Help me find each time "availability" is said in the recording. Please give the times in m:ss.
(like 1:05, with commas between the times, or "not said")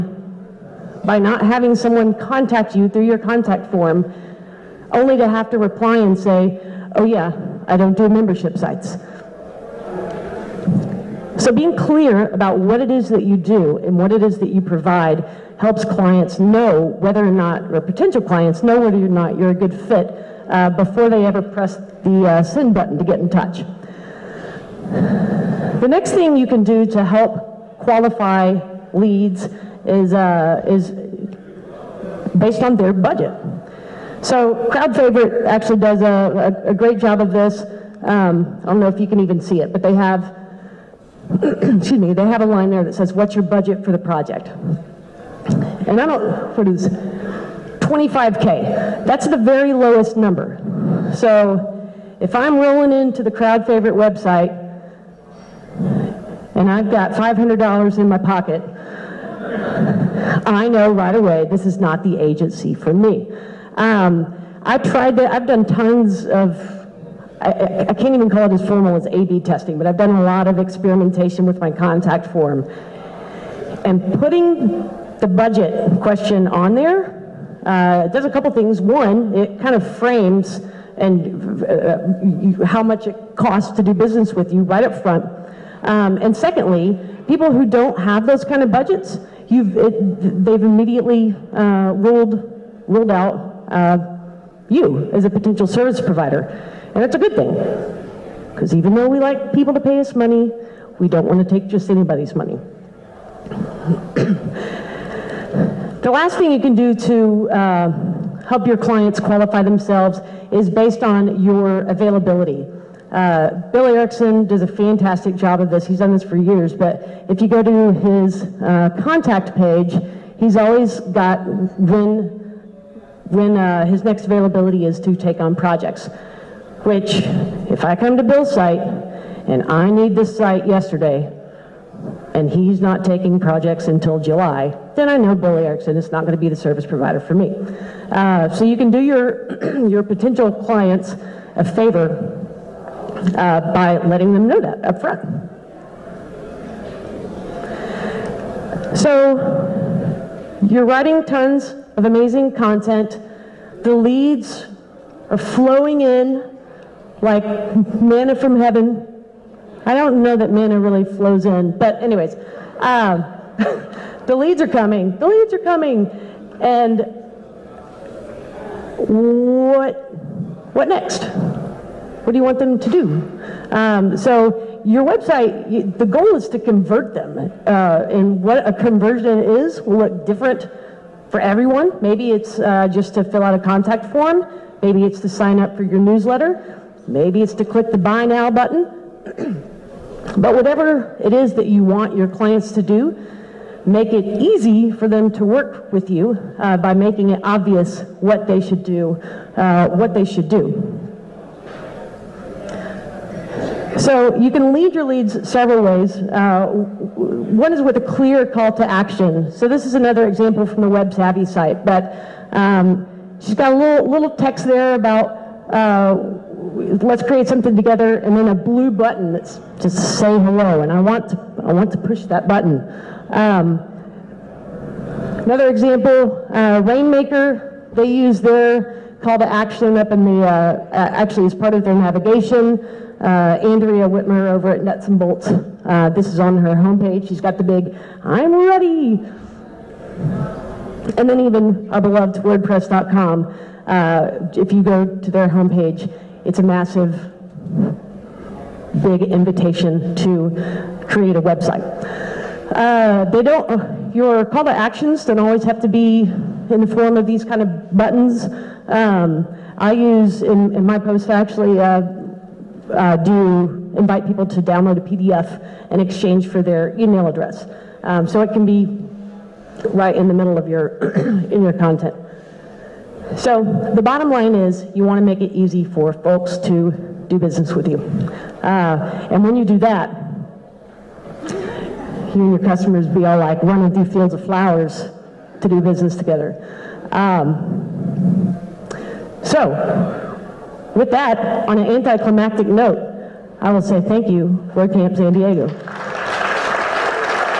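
1:51, 2:04.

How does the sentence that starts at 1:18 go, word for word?
One, it kind of frames and uh, how much it costs to do business with you right up front.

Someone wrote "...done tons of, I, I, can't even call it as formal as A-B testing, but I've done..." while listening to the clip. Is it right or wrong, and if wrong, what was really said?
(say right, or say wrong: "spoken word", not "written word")
right.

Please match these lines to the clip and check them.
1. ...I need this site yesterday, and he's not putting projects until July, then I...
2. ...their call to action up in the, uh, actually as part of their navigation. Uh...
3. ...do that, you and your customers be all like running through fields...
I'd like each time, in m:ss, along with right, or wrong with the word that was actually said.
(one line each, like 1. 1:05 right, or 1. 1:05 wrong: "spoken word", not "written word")
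1. 2:09 wrong: "taking", not "putting"
2. 3:48 right
3. 4:39 right.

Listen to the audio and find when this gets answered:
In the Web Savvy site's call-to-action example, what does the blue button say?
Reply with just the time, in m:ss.
3:40.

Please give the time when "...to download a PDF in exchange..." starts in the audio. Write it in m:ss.
4:24.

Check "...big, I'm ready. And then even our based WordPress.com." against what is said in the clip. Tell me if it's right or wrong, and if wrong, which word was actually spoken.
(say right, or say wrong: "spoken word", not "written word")
wrong: "beloved", not "based".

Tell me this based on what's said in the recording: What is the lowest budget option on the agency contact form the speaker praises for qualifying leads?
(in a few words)
25K.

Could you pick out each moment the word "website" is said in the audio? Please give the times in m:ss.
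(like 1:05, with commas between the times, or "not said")
0:53, 2:55, 4:11.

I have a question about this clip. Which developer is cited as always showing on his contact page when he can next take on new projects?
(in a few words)
Bill Erickson.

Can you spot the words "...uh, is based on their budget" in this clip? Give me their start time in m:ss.
0:30.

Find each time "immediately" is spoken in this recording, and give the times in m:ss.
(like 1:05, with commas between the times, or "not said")
1:30.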